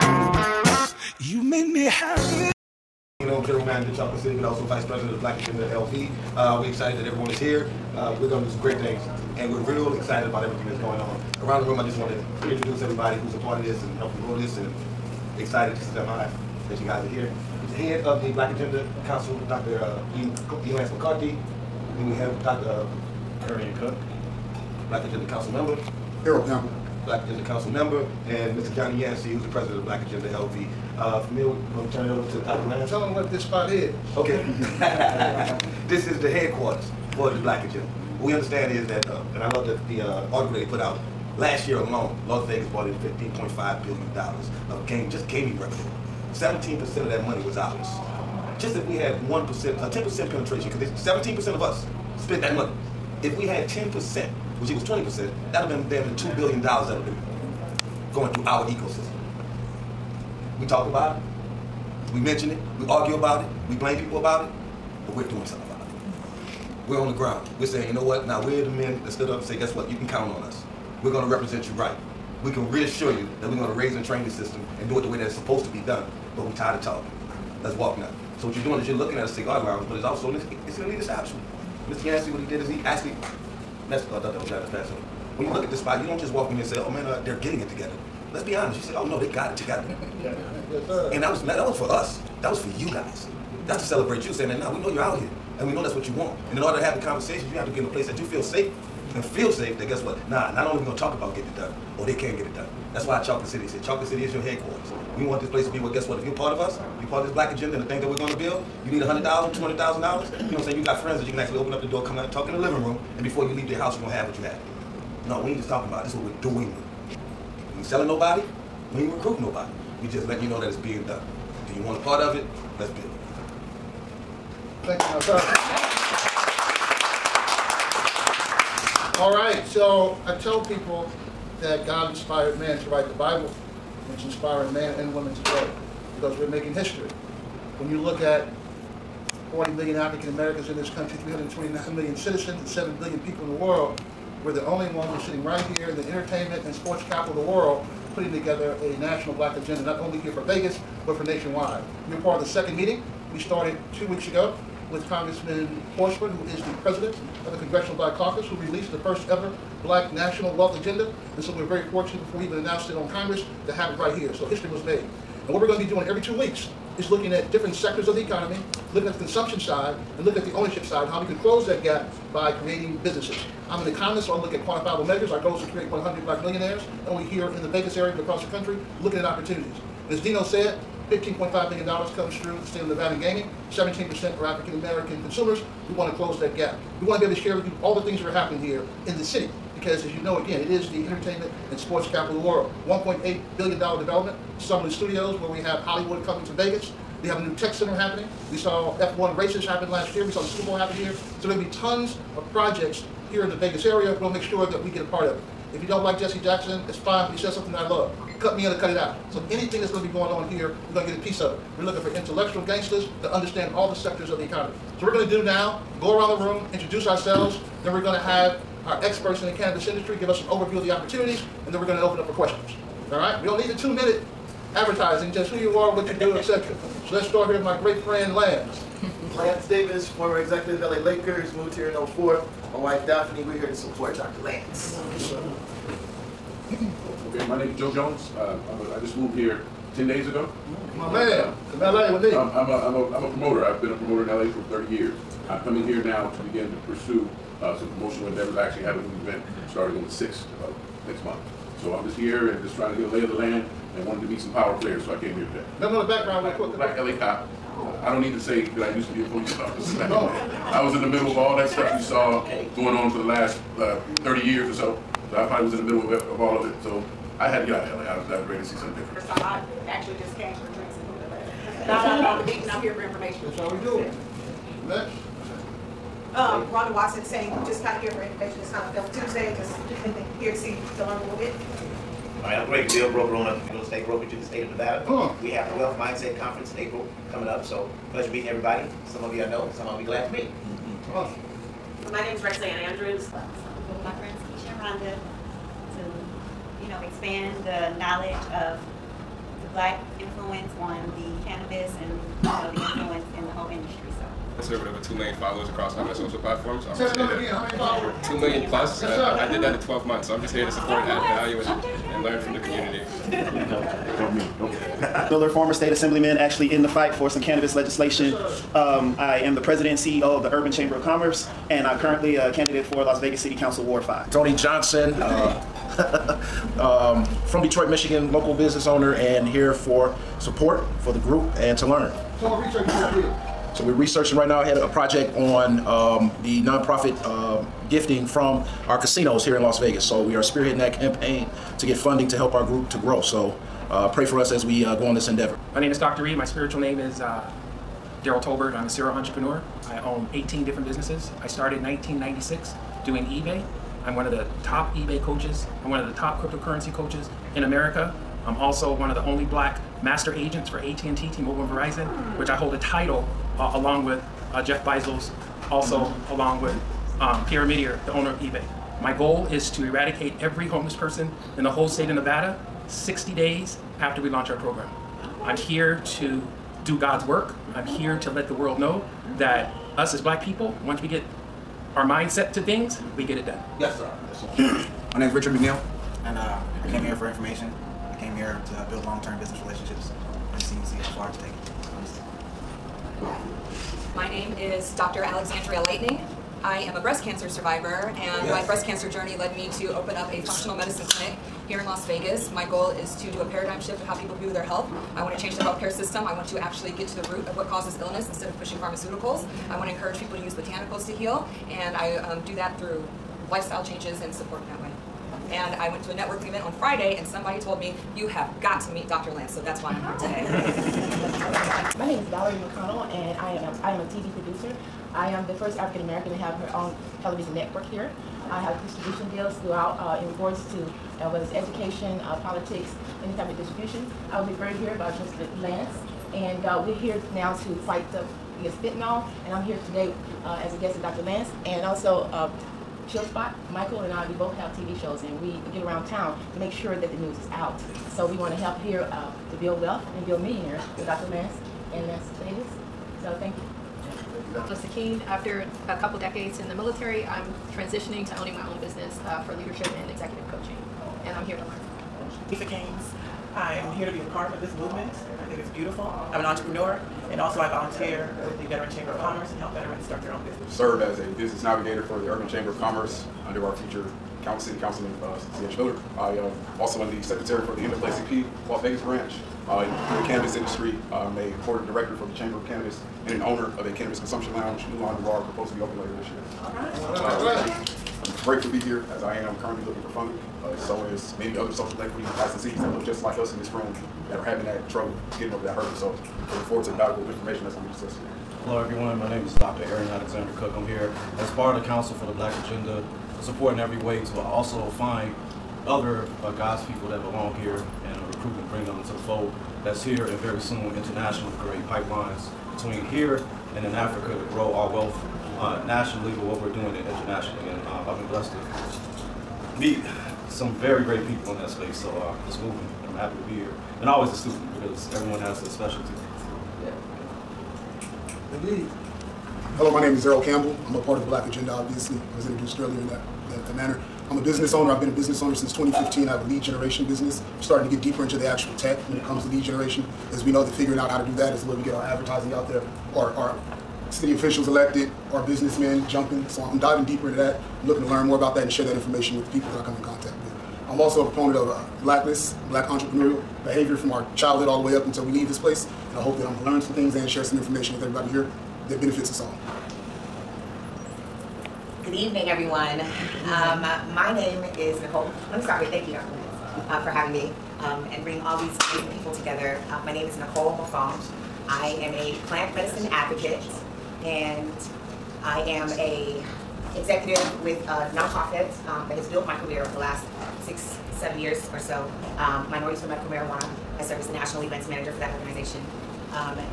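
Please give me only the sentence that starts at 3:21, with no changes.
So there'll be tons of projects here in the Vegas area.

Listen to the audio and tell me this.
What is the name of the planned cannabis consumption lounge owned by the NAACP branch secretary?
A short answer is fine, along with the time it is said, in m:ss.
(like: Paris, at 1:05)
Mulan Noir, at 8:04.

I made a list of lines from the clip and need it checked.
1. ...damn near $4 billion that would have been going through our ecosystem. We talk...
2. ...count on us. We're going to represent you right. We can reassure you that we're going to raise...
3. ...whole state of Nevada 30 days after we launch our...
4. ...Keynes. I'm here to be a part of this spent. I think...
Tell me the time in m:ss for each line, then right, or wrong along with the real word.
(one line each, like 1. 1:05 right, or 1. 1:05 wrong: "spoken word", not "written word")
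1. 0:56 wrong: "2", not "4"
2. 1:10 right
3. 6:11 wrong: "60", not "30"
4. 7:42 wrong: "movement", not "spent".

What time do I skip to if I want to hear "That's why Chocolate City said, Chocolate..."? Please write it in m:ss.
1:42.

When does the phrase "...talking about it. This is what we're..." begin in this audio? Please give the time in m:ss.
1:55.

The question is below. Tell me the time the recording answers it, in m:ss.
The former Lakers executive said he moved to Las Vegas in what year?
3:52.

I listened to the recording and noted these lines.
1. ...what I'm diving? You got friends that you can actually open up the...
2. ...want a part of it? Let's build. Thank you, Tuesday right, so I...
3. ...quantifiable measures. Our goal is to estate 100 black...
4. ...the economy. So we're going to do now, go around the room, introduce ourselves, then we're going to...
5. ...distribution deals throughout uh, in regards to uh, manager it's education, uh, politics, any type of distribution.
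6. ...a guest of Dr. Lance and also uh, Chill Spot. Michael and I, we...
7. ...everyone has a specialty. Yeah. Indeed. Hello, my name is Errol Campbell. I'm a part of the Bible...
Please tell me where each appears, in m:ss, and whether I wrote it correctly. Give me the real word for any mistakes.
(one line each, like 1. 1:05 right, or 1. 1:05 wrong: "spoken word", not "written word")
1. 1:50 wrong: "saying", not "diving"
2. 2:01 wrong: "All", not "Tuesday"
3. 2:54 wrong: "create", not "estate"
4. 3:34 right
5. 7:08 wrong: "whether", not "manager"
6. 7:20 right
7. 8:45 wrong: "Black", not "Bible".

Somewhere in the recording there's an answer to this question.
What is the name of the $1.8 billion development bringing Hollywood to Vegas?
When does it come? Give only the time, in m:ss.
3:14.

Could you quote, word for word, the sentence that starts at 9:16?
And I hope that I'm going to learn some things and share some information with everybody here that benefits us all.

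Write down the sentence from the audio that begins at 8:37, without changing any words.
And uh, I've been blessed to meet some very great people in that space.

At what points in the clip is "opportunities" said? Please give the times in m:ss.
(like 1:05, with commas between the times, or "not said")
2:59, 3:40.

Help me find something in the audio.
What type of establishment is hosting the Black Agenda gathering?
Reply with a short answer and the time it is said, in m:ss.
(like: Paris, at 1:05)
cigar lounge, at 1:19.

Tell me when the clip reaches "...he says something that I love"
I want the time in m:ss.
3:27.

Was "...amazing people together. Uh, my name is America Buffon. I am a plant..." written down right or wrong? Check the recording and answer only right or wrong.
wrong.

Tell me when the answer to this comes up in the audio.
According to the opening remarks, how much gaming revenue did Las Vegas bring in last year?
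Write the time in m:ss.
0:43.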